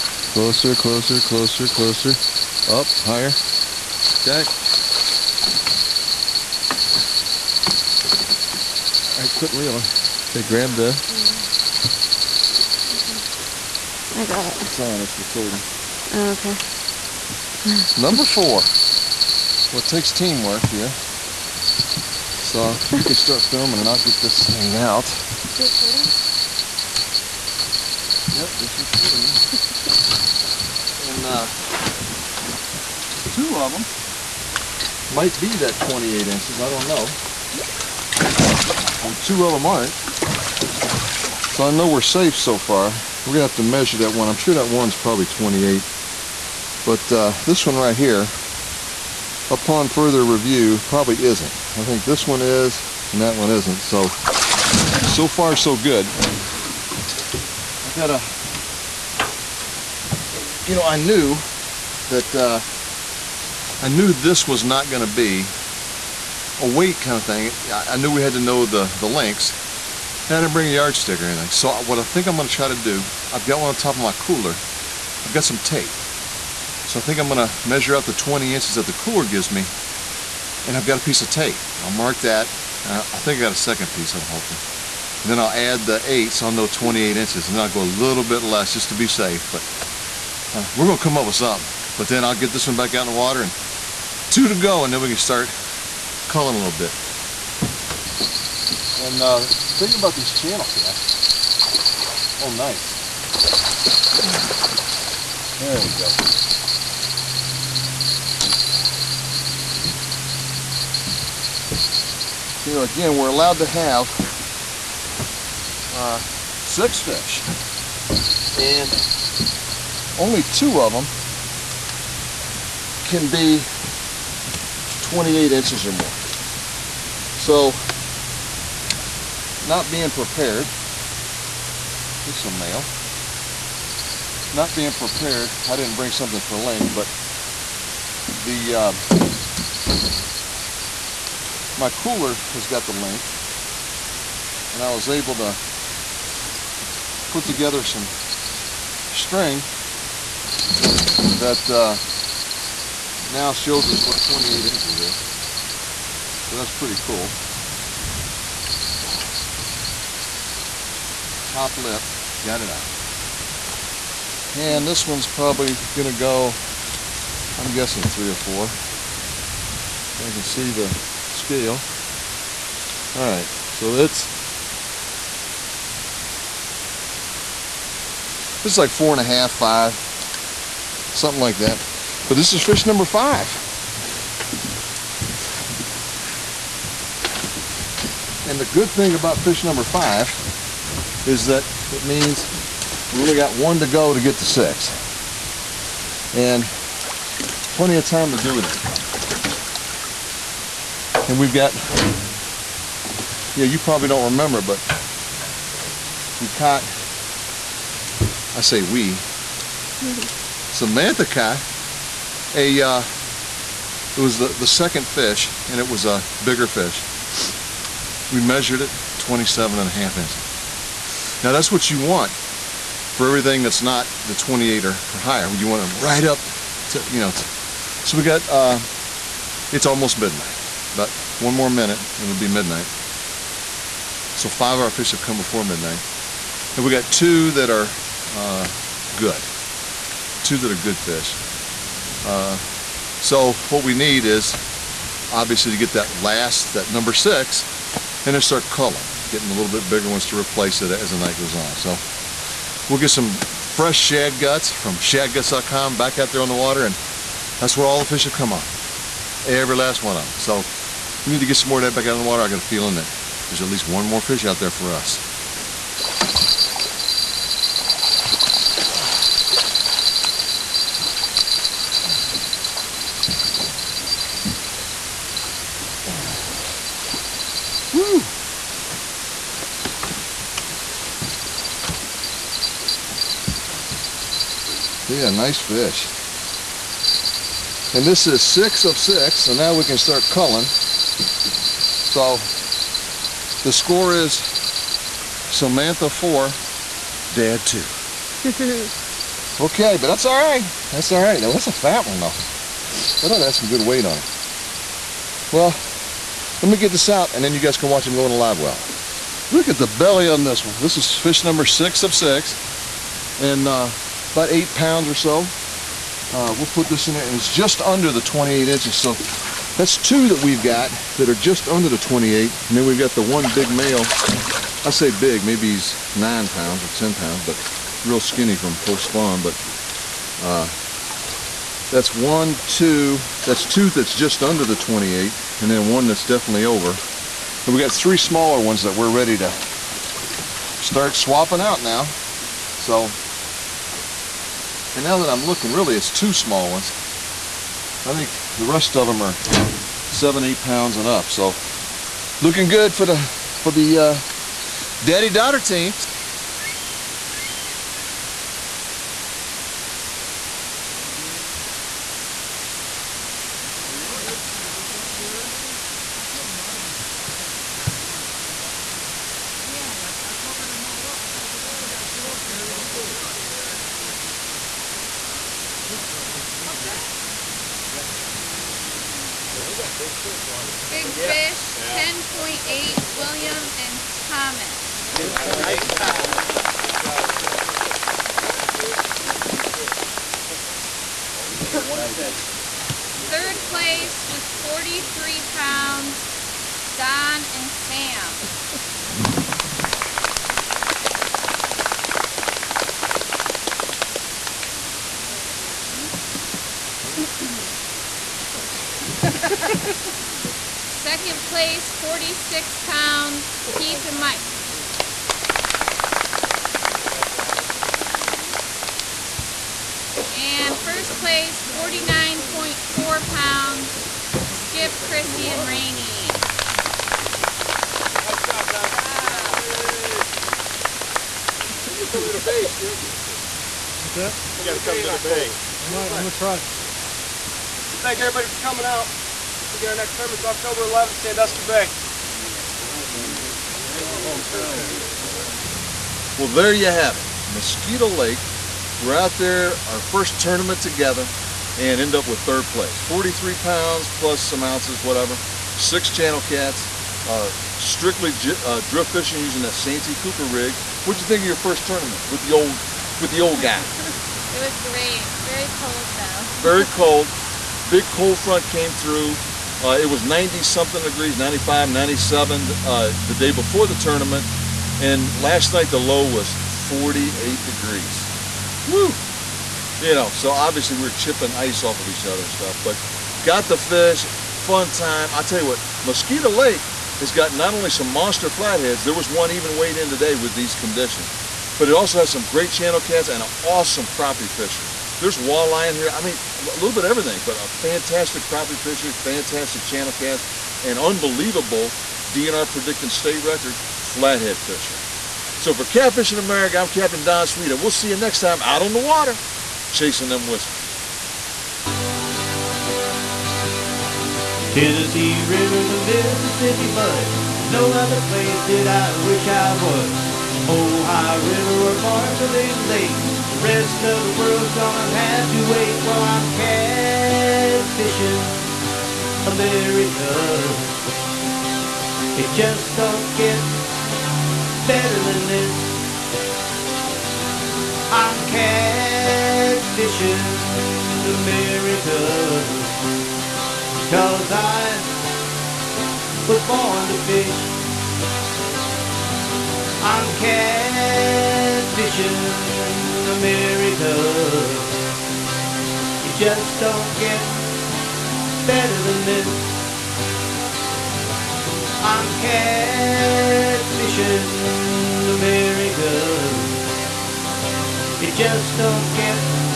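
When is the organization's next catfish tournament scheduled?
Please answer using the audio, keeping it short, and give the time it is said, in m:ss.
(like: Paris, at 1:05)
October 11th, at 7:20.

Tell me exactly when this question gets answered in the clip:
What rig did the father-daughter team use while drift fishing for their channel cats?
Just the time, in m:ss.
7:39.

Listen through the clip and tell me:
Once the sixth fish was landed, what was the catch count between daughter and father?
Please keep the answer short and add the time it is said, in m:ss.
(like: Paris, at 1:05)
Samantha 4, Dad 2, at 4:55.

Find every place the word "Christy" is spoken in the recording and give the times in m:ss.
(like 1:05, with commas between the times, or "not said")
7:04.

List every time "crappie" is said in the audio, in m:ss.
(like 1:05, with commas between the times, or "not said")
8:14, 8:18.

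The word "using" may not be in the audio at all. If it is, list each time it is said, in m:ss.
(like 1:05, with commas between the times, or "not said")
7:39.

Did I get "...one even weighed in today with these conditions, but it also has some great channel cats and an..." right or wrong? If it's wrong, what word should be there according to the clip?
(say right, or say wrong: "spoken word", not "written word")
right.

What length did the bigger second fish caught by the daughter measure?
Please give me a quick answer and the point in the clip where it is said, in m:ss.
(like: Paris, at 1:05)
27 and a half inches, at 3:39.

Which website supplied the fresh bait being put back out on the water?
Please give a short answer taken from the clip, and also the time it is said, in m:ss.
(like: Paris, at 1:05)
shadguts.com, at 4:14.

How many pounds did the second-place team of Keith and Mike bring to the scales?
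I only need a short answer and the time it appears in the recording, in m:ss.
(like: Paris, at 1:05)
46 pounds, at 6:51.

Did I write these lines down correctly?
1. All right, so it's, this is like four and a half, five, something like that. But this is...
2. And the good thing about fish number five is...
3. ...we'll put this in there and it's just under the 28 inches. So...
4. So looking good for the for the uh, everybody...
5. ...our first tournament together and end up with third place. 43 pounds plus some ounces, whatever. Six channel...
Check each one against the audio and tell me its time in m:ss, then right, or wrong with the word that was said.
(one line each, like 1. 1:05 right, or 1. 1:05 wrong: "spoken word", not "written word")
1. 2:53 right
2. 3:08 right
3. 5:16 right
4. 5:51 wrong: "daddy", not "everybody"
5. 7:29 right.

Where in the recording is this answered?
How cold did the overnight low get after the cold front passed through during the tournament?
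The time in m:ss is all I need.
7:56.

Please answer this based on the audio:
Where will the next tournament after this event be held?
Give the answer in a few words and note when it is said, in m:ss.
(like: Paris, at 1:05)
Sandusky Bay, at 7:21.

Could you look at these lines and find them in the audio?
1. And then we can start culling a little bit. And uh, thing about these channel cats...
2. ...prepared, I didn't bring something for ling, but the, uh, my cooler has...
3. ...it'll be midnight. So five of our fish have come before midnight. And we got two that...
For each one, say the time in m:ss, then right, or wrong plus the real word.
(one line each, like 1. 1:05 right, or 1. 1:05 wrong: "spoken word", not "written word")
1. 1:34 right
2. 2:14 right
3. 3:52 right.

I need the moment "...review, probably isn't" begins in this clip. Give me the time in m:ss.
0:50.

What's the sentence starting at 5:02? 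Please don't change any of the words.
That ought to have some good weight on it.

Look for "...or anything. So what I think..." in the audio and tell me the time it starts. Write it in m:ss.
1:11.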